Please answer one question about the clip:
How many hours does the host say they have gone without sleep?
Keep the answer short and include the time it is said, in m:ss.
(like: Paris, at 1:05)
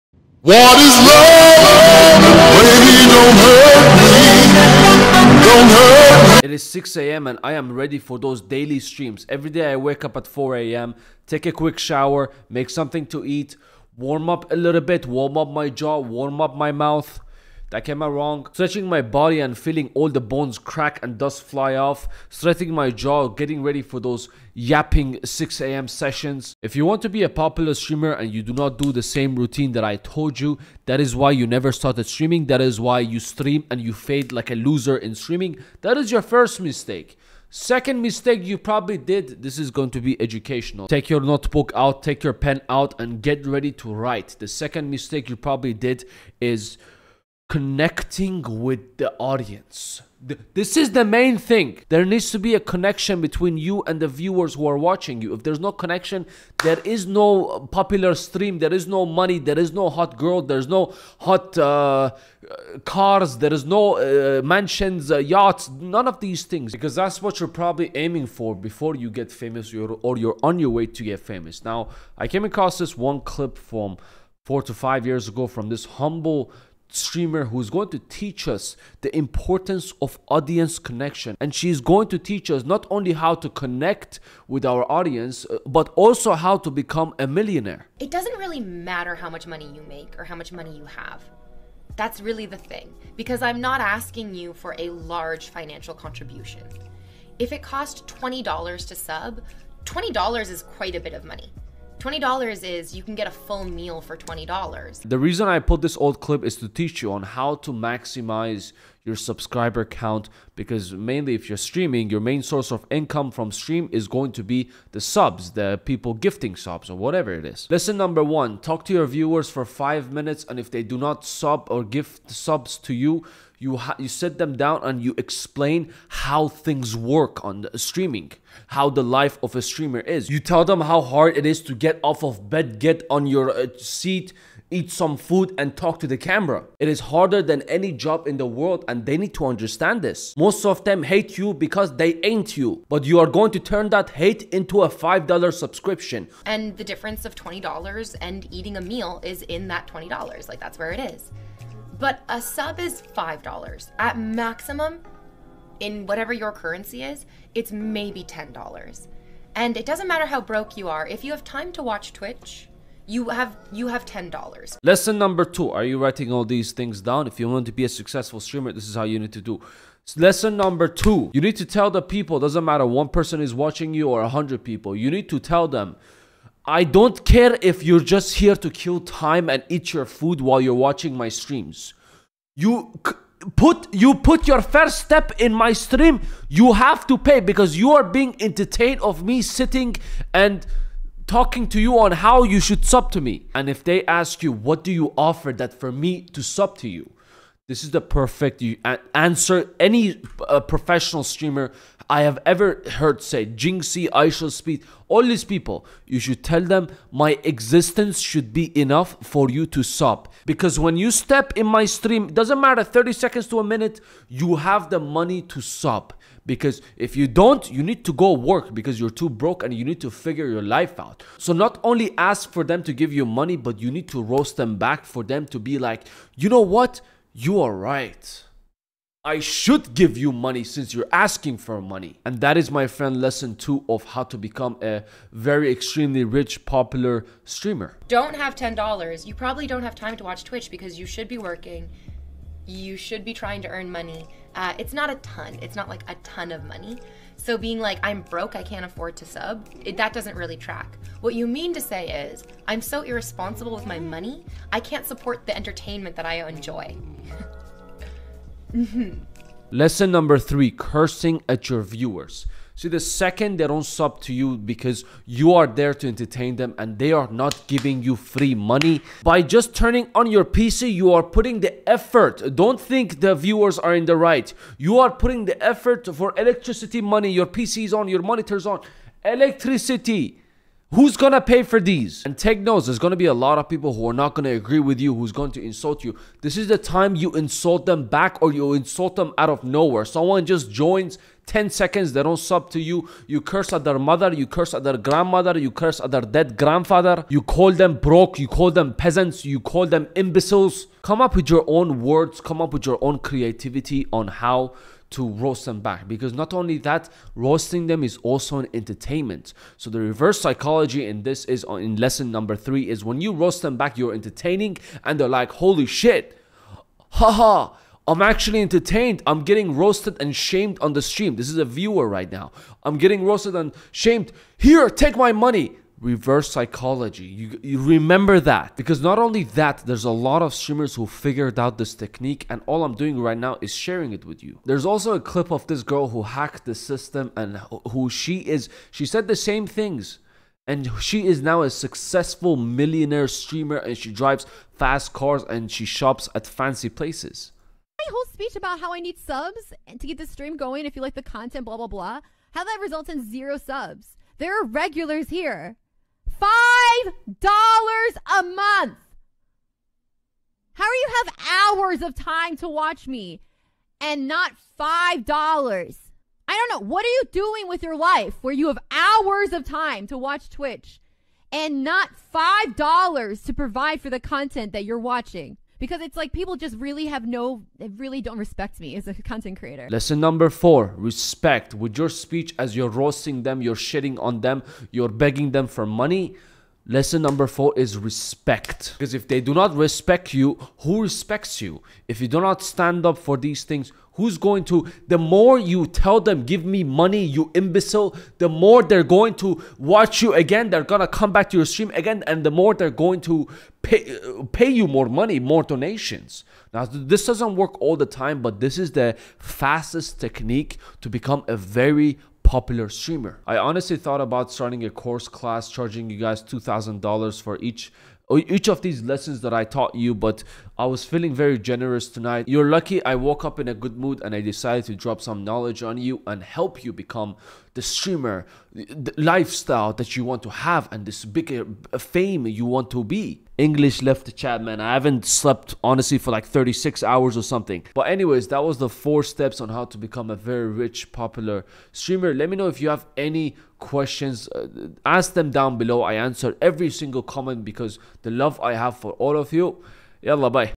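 36 hours, at 7:16.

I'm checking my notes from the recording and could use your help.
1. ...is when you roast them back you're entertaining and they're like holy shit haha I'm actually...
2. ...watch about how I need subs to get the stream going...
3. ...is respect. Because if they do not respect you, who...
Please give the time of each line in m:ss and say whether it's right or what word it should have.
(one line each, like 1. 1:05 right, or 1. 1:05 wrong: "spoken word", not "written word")
1. 5:12 right
2. 5:48 wrong: "speech", not "watch"
3. 6:27 right.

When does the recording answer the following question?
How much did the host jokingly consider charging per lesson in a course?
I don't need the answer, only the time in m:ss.
6:56.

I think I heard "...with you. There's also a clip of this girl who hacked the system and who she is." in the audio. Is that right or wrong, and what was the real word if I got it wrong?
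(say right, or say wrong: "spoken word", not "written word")
right.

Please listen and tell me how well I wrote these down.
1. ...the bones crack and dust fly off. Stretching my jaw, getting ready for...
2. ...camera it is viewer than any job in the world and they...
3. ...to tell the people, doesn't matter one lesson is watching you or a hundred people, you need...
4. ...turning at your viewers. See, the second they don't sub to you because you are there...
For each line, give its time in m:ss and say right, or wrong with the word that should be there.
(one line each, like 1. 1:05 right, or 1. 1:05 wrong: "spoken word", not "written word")
1. 0:20 right
2. 2:16 wrong: "harder", not "viewer"
3. 2:51 wrong: "person", not "lesson"
4. 4:20 wrong: "cursing", not "turning".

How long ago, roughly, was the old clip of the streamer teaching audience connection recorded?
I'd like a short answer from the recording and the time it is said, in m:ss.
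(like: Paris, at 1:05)
4 to 5 years ago, at 1:14.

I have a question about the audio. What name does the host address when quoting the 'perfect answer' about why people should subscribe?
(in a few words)
Jinxie.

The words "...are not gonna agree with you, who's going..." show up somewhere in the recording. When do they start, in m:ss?
4:44.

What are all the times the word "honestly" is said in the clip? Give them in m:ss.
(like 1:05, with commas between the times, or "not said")
6:53, 7:15.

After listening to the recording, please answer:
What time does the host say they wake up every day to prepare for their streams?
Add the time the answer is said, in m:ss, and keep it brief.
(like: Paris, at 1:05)
4 a.m., at 0:10.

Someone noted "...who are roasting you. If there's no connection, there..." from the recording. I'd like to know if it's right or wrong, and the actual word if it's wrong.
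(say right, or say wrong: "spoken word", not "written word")
wrong: "watching", not "roasting".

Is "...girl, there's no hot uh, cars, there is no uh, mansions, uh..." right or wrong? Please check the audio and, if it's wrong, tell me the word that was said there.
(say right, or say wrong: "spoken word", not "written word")
right.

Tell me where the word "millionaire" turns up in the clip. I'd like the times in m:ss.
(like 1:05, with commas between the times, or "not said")
1:27, 5:42.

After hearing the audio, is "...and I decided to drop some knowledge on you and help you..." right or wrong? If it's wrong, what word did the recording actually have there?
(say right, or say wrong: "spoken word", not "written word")
right.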